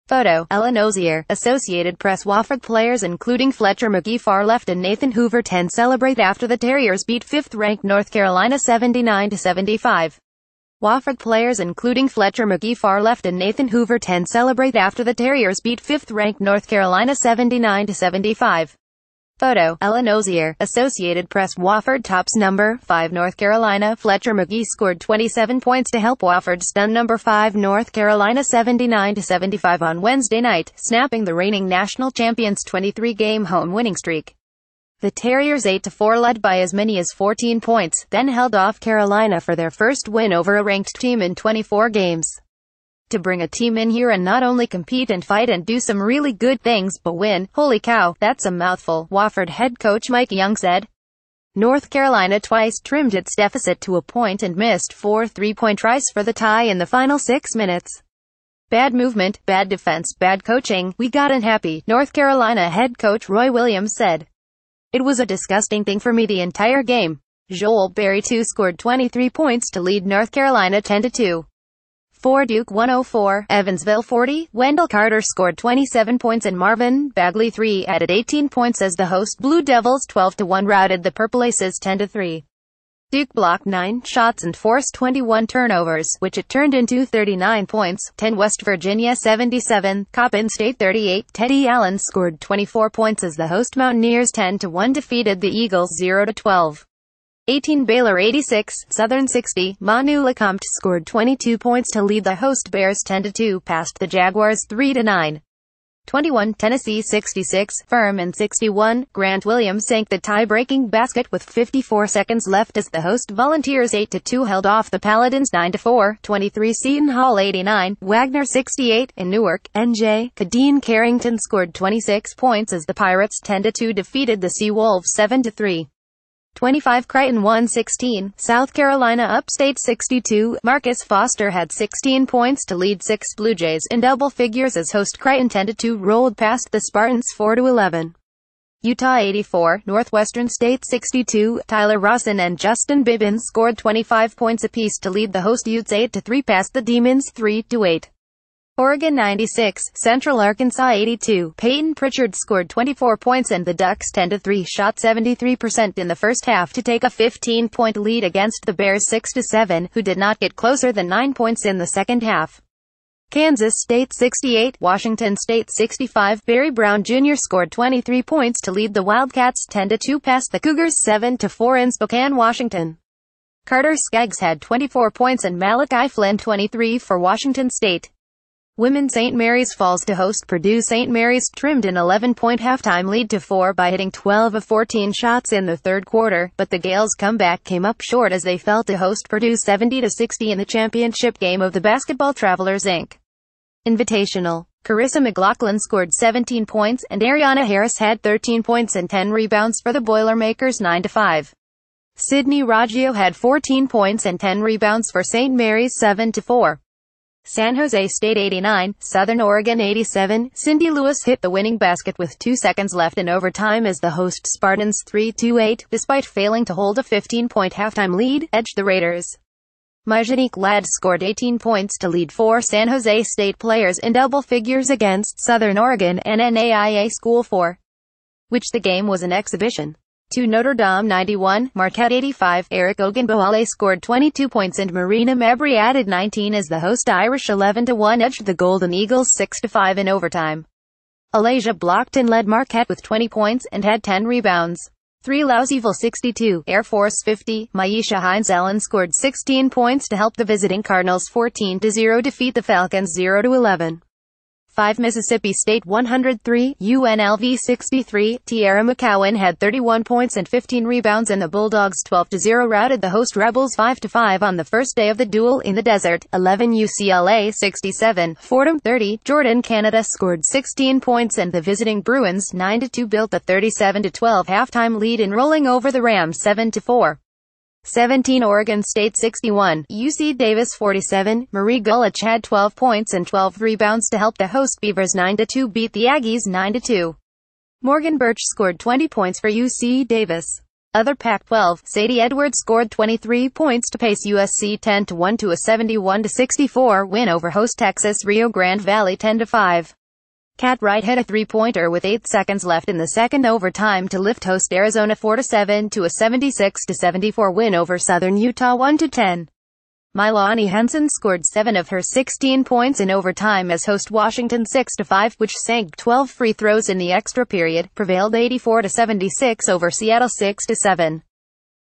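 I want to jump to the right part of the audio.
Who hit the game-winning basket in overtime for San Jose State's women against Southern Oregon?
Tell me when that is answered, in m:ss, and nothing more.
3:30.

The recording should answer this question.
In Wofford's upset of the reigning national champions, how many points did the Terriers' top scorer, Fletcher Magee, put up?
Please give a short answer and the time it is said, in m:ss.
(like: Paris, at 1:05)
27, at 0:25.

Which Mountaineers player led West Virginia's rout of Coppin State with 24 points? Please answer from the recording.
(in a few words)
Teddy Allen.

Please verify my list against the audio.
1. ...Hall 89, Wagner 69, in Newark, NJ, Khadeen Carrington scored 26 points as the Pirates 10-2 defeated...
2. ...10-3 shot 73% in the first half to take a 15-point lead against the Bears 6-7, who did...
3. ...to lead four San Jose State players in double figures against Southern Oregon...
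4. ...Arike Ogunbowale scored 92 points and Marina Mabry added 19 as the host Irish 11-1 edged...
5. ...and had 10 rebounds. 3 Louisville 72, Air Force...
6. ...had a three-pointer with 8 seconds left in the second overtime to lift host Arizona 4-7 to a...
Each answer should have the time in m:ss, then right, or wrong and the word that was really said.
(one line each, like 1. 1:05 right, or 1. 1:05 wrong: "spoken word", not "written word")
1. 1:57 wrong: "68", not "69"
2. 2:34 right
3. 3:41 right
4. 3:52 wrong: "22", not "92"
5. 4:03 wrong: "62", not "72"
6. 5:01 right.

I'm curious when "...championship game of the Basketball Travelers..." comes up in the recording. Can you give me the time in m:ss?
3:10.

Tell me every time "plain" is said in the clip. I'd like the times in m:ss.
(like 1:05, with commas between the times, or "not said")
not said.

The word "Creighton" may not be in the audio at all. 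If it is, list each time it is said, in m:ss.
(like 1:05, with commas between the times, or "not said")
2:07, 2:15.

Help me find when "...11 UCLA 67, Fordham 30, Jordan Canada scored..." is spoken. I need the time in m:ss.
4:26.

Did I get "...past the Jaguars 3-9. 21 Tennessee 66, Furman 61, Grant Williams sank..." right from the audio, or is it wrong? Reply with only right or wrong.
right.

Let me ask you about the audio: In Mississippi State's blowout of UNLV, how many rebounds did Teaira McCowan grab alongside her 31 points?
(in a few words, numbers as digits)
15.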